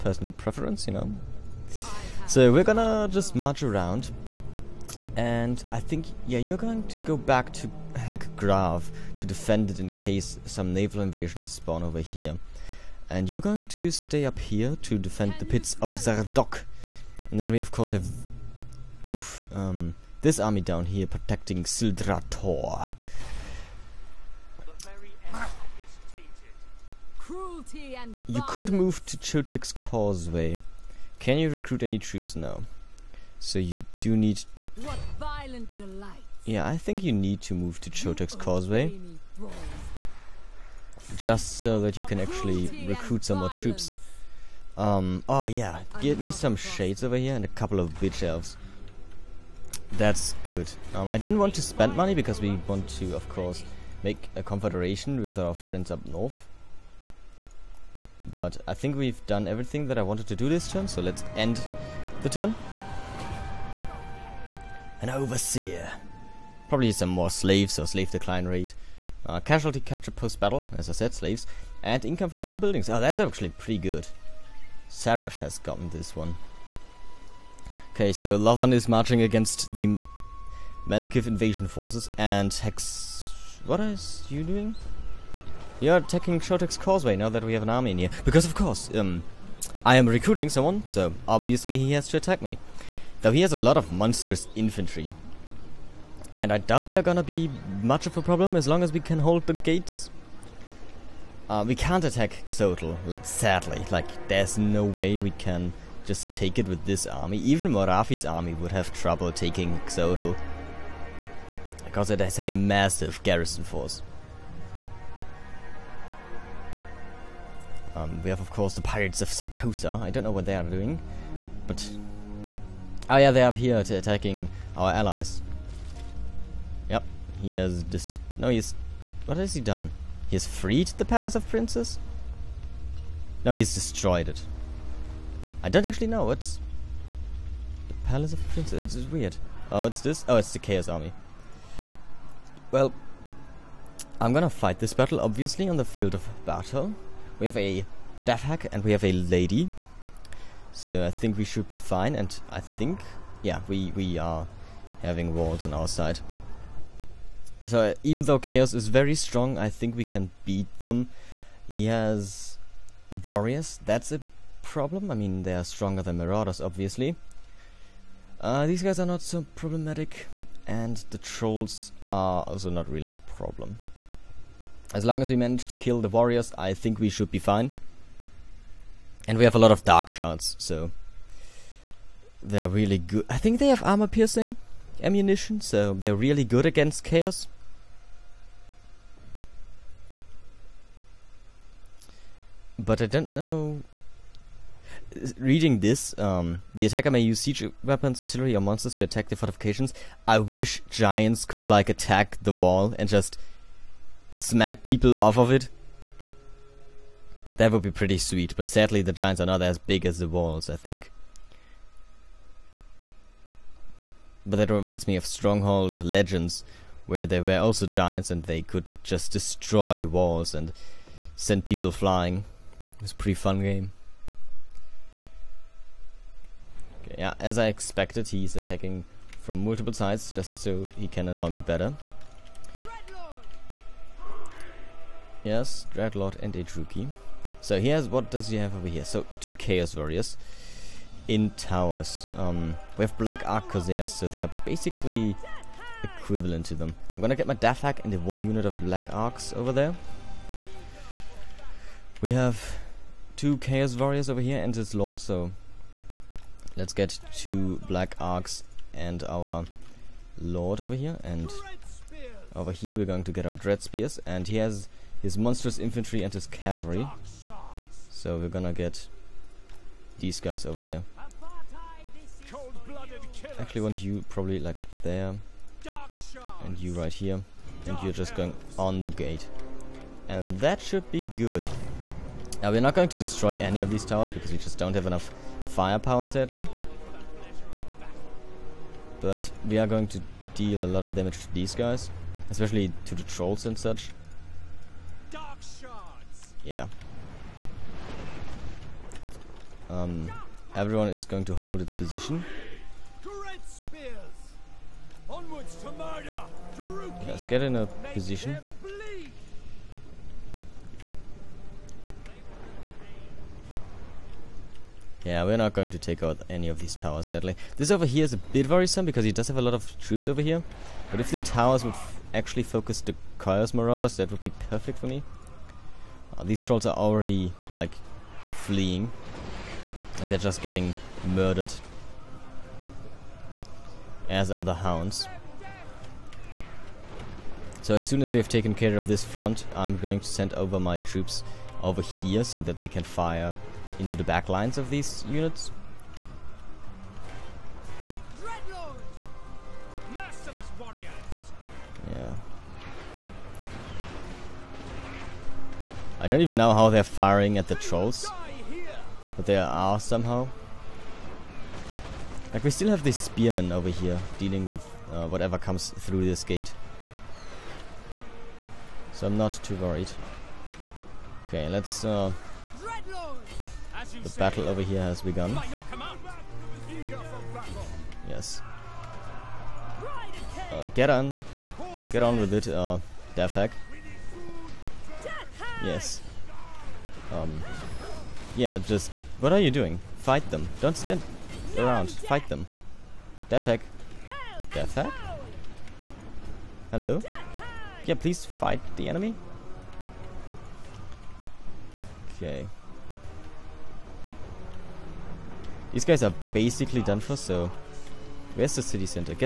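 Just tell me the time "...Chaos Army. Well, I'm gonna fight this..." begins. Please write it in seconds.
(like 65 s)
140 s.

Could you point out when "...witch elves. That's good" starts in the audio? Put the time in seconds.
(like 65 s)
48 s.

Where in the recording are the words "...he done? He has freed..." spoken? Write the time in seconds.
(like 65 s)
129 s.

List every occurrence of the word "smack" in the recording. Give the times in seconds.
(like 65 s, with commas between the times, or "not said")
204 s.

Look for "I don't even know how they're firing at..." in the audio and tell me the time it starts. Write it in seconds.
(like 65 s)
356 s.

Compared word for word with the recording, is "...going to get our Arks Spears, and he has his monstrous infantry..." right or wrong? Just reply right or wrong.
wrong.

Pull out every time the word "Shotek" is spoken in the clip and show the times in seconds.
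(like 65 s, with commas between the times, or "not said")
86 s.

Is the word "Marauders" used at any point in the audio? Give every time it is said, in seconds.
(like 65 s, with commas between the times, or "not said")
166 s, 323 s.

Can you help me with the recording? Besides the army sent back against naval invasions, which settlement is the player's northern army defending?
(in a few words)
Pits of Zardok.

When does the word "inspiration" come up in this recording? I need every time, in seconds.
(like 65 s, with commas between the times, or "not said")
not said.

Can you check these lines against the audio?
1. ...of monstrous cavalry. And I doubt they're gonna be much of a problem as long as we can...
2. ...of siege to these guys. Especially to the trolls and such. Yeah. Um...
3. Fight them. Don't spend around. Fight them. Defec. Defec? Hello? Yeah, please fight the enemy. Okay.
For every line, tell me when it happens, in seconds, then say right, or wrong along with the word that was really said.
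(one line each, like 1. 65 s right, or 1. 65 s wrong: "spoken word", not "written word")
1. 93 s wrong: "infantry", not "cavalry"
2. 291 s wrong: "damage", not "siege"
3. 390 s wrong: "stand", not "spend".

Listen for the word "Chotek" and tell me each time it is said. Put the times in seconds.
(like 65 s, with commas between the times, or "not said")
29 s, 37 s.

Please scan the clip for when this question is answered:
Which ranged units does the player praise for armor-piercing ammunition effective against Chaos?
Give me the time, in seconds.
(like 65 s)
179 s.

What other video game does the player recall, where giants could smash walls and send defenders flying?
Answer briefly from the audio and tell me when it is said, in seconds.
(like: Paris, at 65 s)
Stronghold Legends, at 215 s.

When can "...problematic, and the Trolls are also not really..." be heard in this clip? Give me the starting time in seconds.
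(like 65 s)
169 s.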